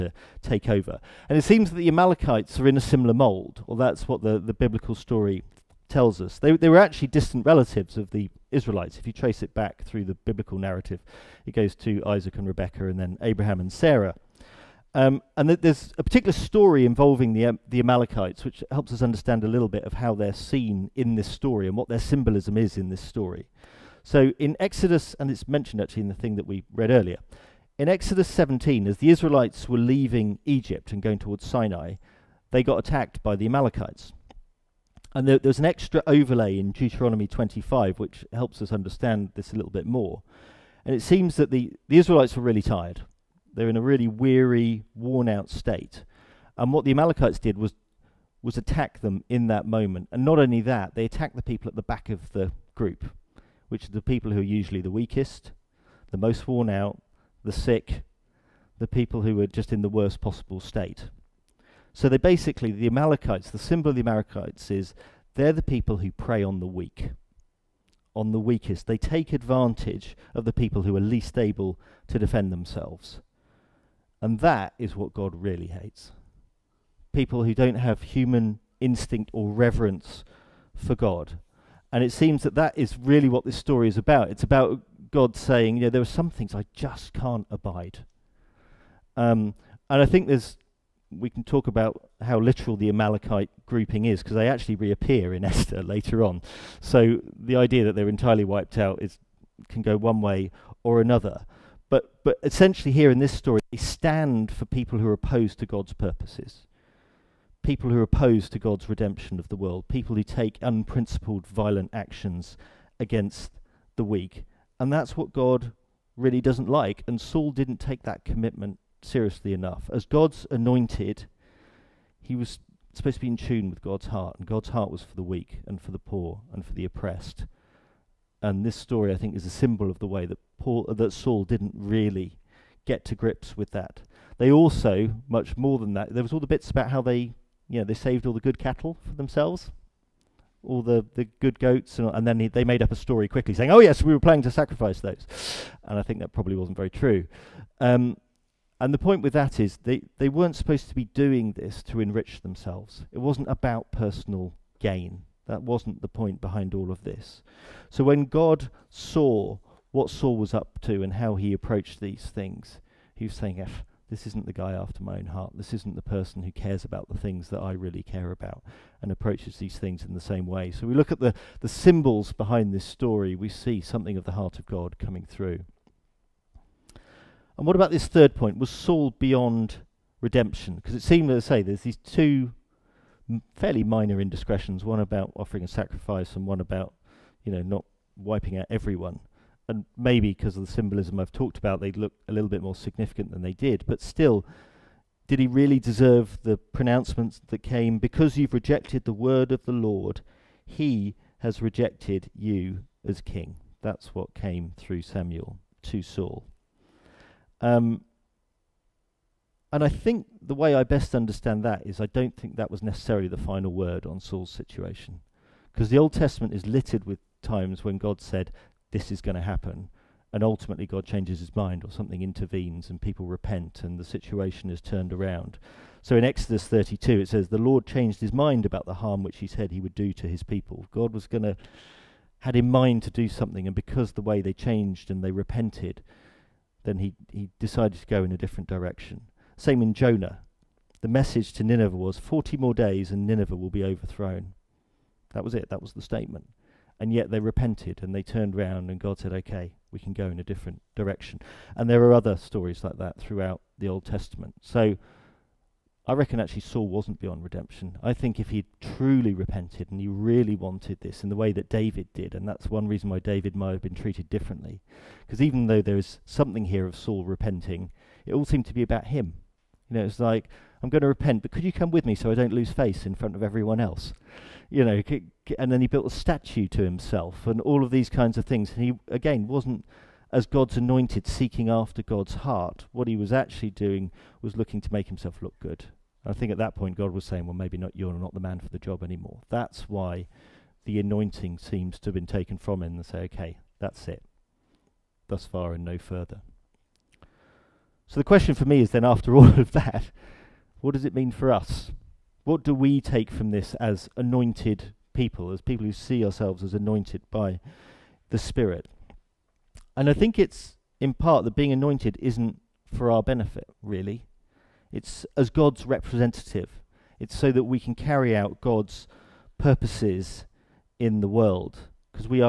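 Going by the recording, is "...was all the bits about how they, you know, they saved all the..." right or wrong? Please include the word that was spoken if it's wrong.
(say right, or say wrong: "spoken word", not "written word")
right.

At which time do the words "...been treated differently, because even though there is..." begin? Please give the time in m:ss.
4:23.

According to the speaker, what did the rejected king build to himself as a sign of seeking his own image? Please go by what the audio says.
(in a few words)
A statue.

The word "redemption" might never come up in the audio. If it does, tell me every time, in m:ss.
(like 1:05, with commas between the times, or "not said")
1:48, 3:00, 4:17.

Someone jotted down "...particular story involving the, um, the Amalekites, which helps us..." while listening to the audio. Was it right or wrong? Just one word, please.
right.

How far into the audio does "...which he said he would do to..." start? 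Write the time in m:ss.
3:49.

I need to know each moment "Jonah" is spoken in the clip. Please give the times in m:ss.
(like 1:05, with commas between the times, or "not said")
3:59.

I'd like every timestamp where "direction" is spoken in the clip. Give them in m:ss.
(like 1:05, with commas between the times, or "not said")
3:58, 4:10.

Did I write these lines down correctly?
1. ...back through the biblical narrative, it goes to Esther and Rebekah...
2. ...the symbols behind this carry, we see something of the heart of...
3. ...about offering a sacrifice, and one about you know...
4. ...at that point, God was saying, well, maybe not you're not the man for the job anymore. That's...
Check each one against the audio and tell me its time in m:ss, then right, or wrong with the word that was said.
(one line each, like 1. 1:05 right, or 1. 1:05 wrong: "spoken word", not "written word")
1. 0:09 wrong: "Isaac", not "Esther"
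2. 2:51 wrong: "story", not "carry"
3. 3:04 right
4. 4:46 right.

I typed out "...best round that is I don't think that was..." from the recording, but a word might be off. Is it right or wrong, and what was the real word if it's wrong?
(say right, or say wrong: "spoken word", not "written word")
wrong: "understand", not "round".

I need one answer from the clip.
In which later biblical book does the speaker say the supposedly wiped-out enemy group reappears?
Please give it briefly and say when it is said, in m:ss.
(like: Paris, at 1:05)
Esther, at 1:35.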